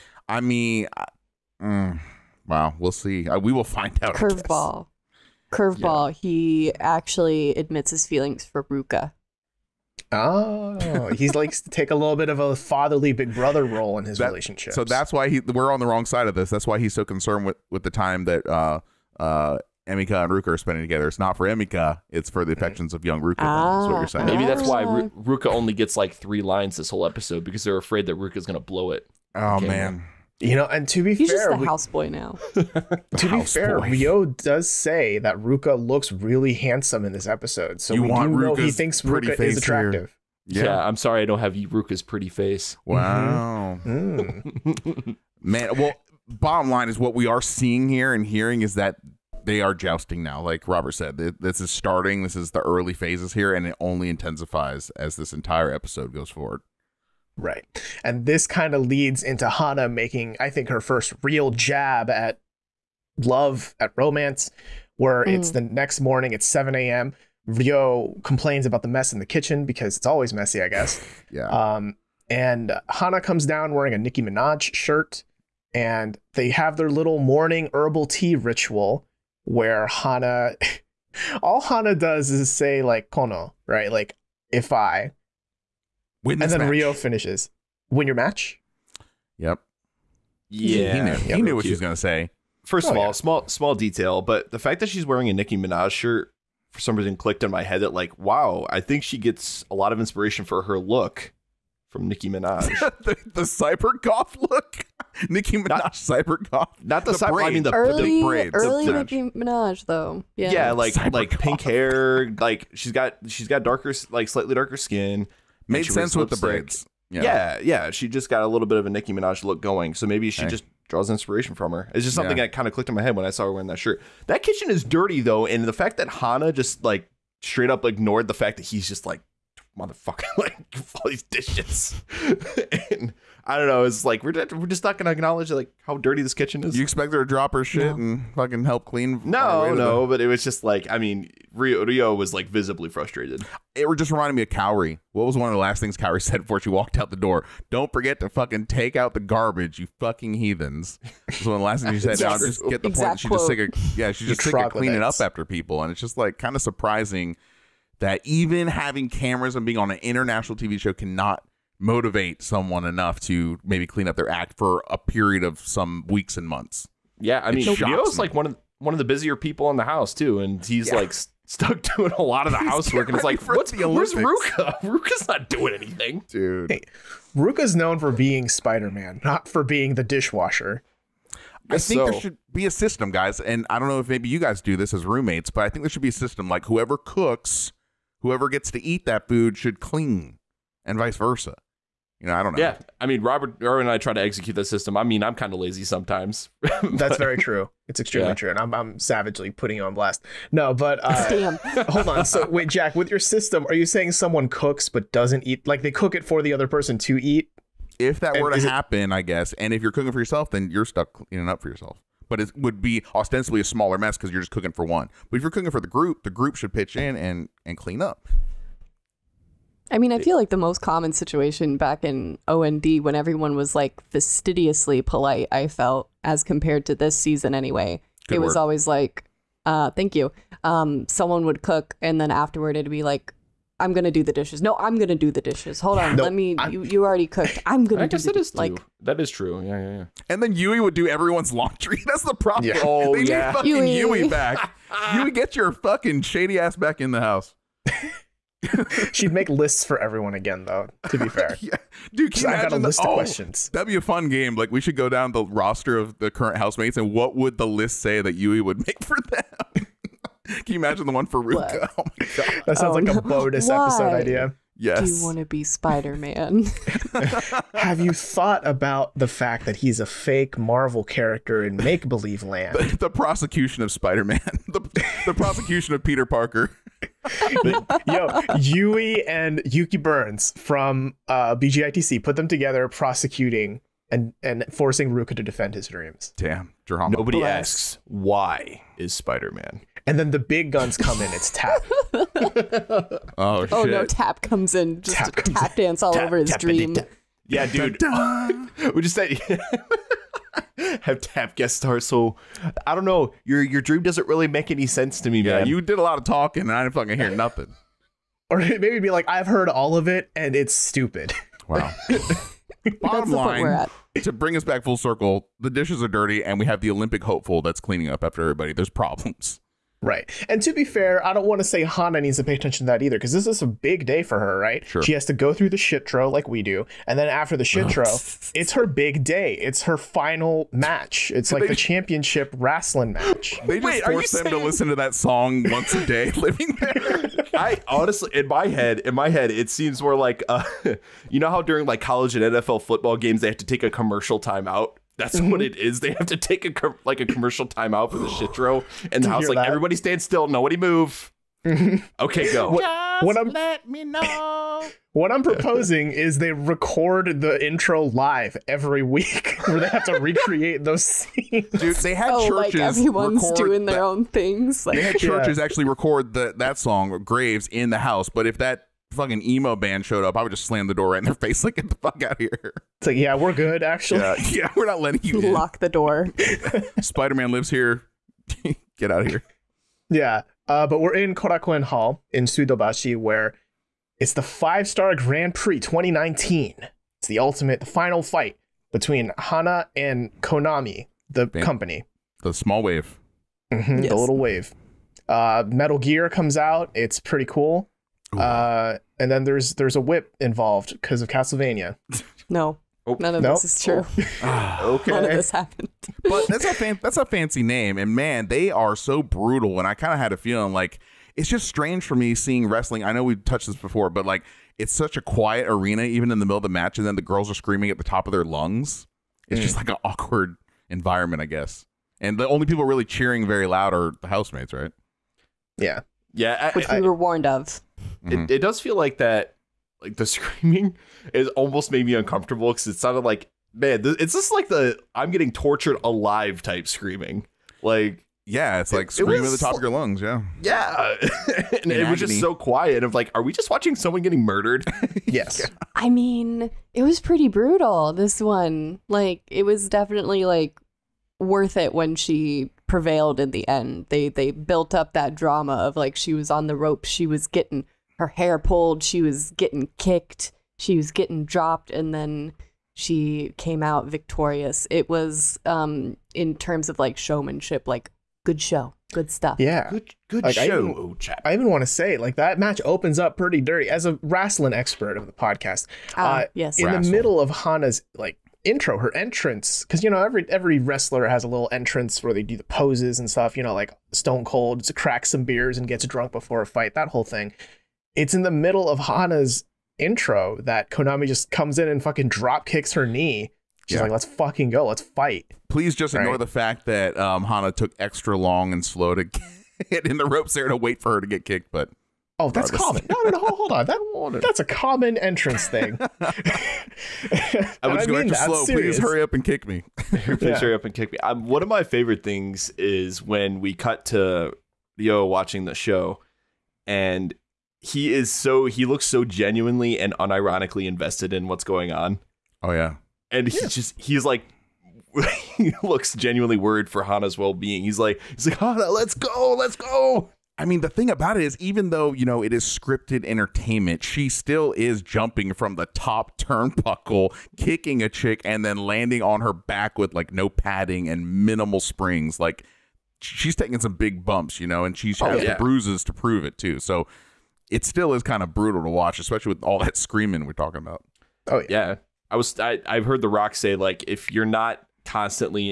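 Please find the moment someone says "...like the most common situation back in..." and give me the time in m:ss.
3:40.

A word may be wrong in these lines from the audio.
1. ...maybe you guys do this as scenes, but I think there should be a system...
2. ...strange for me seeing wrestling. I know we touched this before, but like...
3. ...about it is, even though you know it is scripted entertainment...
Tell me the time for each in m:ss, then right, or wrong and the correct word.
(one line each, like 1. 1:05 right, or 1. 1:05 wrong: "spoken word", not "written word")
1. 3:04 wrong: "roommates", not "scenes"
2. 6:51 right
3. 8:51 right.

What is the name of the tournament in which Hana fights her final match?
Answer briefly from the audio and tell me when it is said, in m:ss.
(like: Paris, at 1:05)
Five Star Grand Prix 2019, at 6:24.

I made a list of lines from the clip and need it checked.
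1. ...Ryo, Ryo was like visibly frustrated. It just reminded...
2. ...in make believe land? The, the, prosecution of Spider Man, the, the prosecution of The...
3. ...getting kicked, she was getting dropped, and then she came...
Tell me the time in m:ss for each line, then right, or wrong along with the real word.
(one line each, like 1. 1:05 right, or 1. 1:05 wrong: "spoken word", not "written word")
1. 2:21 right
2. 4:31 wrong: "Peter", not "The"
3. 7:39 right.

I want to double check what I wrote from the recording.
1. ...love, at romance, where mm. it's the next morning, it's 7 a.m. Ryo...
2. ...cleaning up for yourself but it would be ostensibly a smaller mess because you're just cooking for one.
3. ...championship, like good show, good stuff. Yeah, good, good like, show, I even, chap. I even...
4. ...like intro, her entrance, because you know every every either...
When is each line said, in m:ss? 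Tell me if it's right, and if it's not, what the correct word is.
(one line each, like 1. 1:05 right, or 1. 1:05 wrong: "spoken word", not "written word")
1. 1:03 right
2. 3:31 right
3. 7:47 wrong: "showmanship", not "championship"
4. 7:58 wrong: "wrestler", not "either".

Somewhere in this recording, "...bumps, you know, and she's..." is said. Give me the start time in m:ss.
9:04.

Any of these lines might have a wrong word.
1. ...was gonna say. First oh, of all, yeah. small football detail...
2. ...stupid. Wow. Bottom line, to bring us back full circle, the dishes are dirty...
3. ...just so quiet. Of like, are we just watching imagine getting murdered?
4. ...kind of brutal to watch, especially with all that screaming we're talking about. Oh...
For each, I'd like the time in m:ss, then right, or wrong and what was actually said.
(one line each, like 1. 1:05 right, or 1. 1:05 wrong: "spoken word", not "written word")
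1. 1:31 wrong: "small", not "football"
2. 5:10 right
3. 7:22 wrong: "someone", not "imagine"
4. 9:08 right.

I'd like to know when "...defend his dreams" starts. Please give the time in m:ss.
4:45.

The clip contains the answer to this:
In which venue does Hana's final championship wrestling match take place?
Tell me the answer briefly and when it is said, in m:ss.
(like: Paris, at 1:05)
Korakuen Hall, at 6:21.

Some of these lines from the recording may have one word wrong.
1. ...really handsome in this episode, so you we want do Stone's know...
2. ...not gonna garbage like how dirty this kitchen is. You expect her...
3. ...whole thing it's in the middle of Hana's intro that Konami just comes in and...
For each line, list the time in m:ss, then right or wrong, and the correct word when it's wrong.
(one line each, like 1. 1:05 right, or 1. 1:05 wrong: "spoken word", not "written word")
1. 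0:36 wrong: "Ruka", not "Stone"
2. 2:14 wrong: "acknowledge", not "garbage"
3. 8:07 right.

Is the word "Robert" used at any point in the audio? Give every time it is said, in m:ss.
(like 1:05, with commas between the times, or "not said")
0:50, 3:13.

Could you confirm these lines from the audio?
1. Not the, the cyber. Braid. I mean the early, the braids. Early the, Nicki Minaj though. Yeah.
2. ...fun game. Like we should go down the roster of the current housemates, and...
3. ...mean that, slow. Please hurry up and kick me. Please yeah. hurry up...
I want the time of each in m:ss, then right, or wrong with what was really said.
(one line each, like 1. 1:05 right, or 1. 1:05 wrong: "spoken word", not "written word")
1. 1:46 right
2. 4:14 right
3. 8:28 right.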